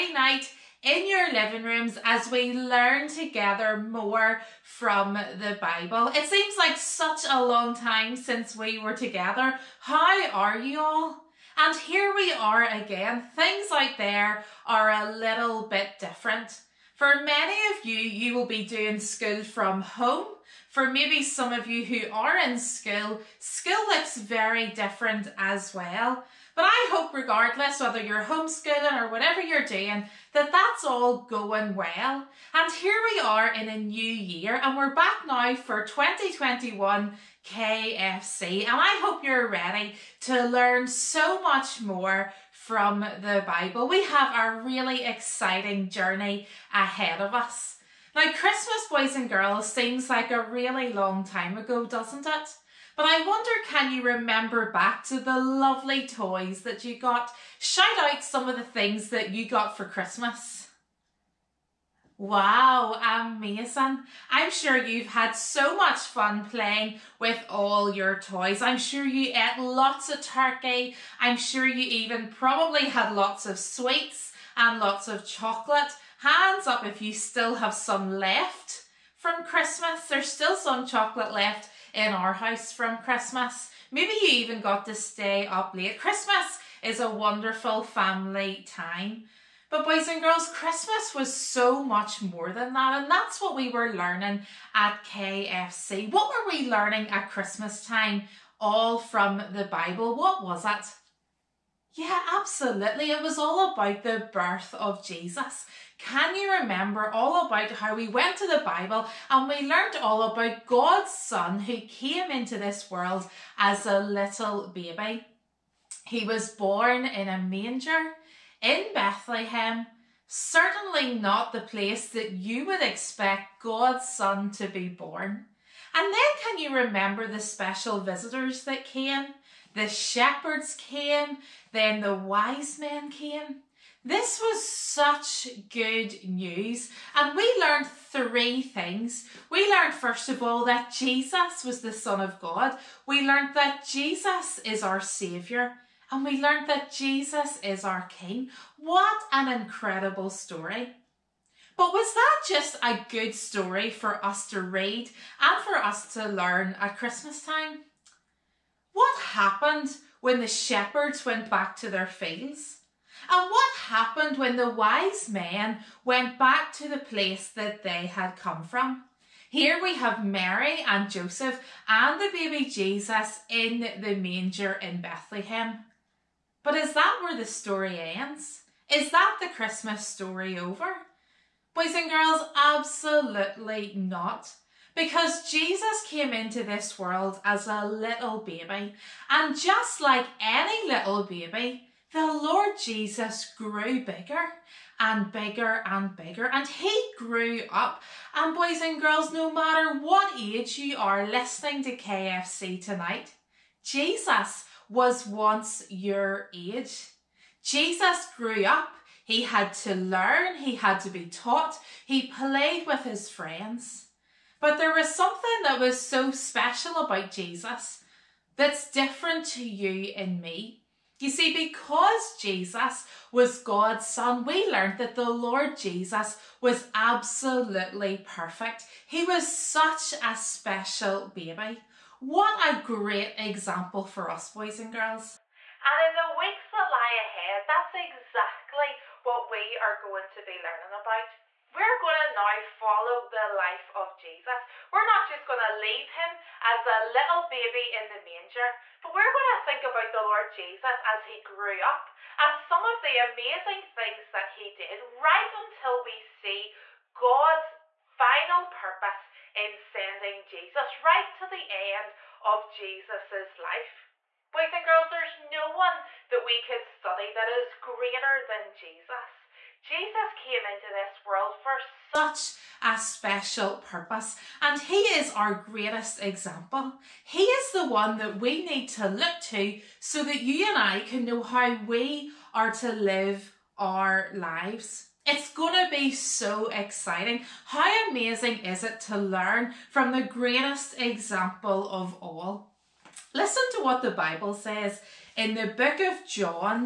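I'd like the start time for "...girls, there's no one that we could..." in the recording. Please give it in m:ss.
4:24.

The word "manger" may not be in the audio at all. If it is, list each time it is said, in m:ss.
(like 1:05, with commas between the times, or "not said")
1:57, 2:54, 4:08.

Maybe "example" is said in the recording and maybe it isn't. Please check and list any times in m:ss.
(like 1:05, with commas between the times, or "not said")
3:53, 4:36, 4:50.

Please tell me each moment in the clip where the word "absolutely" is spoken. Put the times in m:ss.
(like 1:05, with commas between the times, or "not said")
1:42, 3:02, 3:46.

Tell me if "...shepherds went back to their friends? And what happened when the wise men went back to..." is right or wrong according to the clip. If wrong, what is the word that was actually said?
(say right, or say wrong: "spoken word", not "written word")
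wrong: "fields", not "friends".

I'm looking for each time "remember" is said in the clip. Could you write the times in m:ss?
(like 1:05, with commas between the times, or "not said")
0:54, 1:46, 2:06.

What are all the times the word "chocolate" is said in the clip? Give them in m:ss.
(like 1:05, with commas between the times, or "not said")
1:15, 1:20.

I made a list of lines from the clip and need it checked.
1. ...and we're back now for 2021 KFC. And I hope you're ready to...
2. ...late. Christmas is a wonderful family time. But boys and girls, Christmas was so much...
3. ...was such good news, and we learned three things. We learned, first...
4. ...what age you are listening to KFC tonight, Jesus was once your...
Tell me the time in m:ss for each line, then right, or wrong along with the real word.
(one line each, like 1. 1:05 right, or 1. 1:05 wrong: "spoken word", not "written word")
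1. 0:34 right
2. 1:25 right
3. 2:14 right
4. 3:20 right.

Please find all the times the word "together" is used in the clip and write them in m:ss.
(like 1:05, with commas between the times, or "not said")
0:03, 0:08.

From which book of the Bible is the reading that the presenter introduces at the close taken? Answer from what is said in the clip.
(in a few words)
John.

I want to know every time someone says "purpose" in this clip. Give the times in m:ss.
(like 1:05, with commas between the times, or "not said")
4:18, 4:33.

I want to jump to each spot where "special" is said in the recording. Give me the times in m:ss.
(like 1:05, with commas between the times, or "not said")
2:07, 3:36, 3:50, 4:32.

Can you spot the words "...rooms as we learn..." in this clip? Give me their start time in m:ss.
0:01.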